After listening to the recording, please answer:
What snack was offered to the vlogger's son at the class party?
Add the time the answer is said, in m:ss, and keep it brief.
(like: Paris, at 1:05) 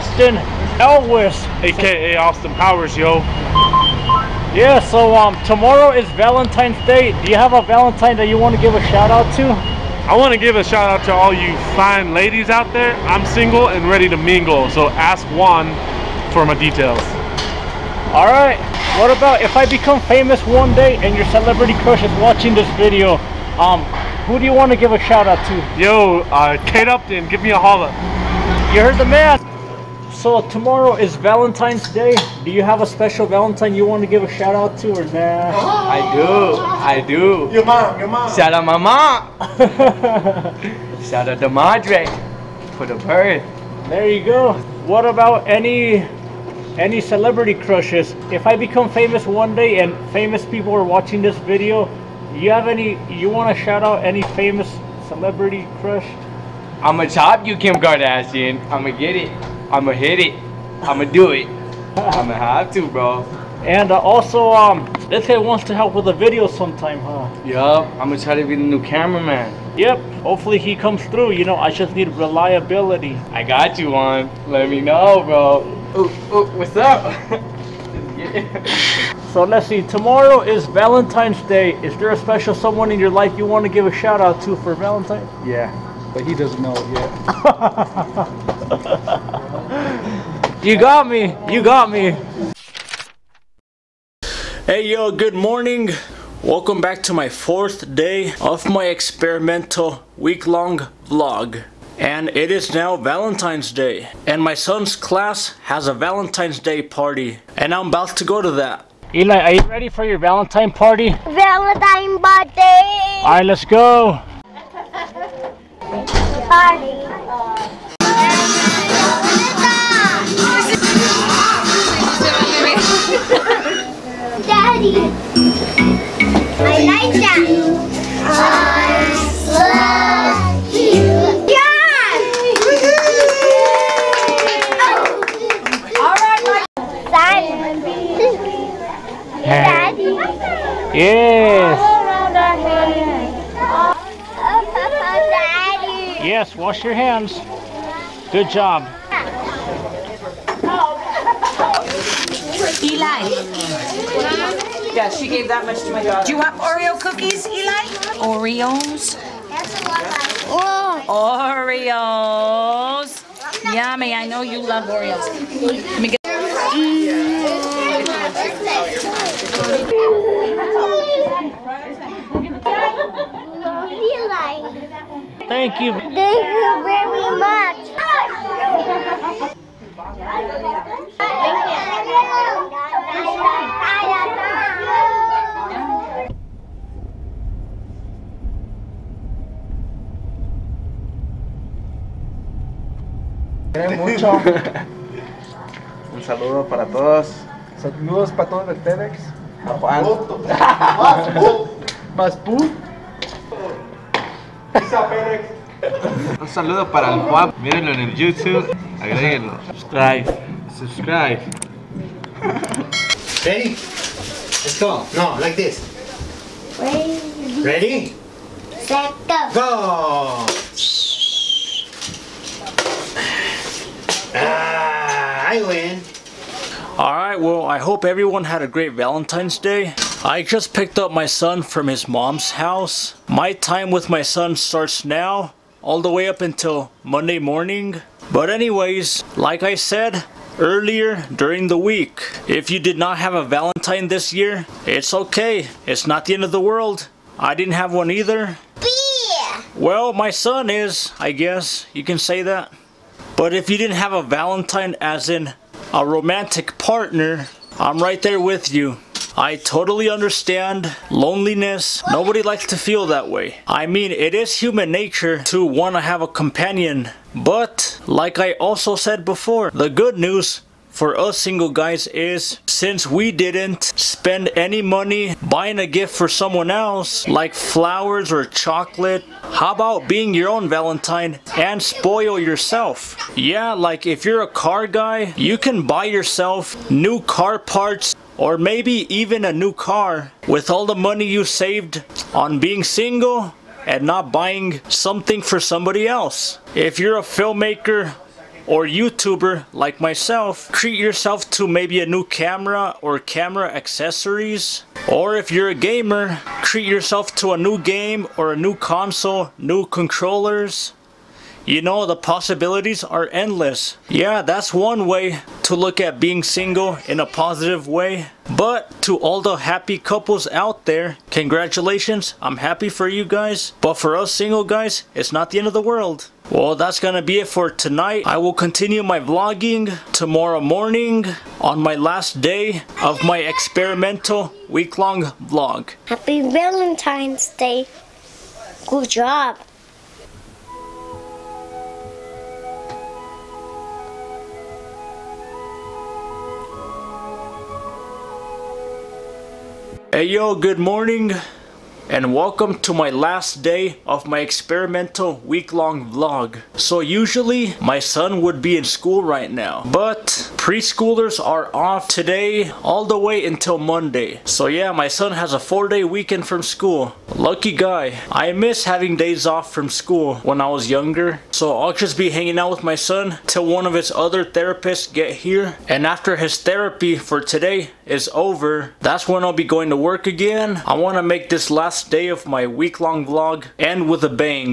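Oreo cookies, at 2:36.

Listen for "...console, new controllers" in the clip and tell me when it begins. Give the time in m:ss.
5:08.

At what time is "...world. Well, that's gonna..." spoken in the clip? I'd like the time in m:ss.
5:25.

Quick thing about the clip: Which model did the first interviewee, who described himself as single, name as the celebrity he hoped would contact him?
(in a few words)
Kate Upton.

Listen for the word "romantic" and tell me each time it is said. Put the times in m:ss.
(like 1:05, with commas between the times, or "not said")
4:16.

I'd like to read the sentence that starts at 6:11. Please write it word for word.
So I'll just be hanging out with my son till one of his other therapists get here.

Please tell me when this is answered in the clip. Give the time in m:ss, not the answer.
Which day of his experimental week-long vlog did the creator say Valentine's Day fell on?
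1:37.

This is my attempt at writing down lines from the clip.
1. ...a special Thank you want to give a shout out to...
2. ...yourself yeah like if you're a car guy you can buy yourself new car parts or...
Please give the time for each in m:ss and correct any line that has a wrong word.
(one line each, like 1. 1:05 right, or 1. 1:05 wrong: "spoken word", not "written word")
1. 0:32 wrong: "Valentine", not "Thank"
2. 4:42 right.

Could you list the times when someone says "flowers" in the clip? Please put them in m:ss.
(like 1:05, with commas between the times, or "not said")
4:37.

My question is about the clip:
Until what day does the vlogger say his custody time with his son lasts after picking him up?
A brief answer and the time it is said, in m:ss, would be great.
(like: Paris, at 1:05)
Monday morning, at 3:57.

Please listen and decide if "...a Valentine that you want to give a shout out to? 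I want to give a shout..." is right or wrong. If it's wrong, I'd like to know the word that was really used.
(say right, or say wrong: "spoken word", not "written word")
right.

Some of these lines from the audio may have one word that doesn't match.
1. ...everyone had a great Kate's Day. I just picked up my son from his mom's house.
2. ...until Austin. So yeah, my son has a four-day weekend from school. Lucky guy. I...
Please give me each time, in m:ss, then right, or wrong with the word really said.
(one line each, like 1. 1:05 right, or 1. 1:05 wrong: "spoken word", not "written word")
1. 3:48 wrong: "Valentine", not "Kate"
2. 6:03 wrong: "Monday", not "Austin".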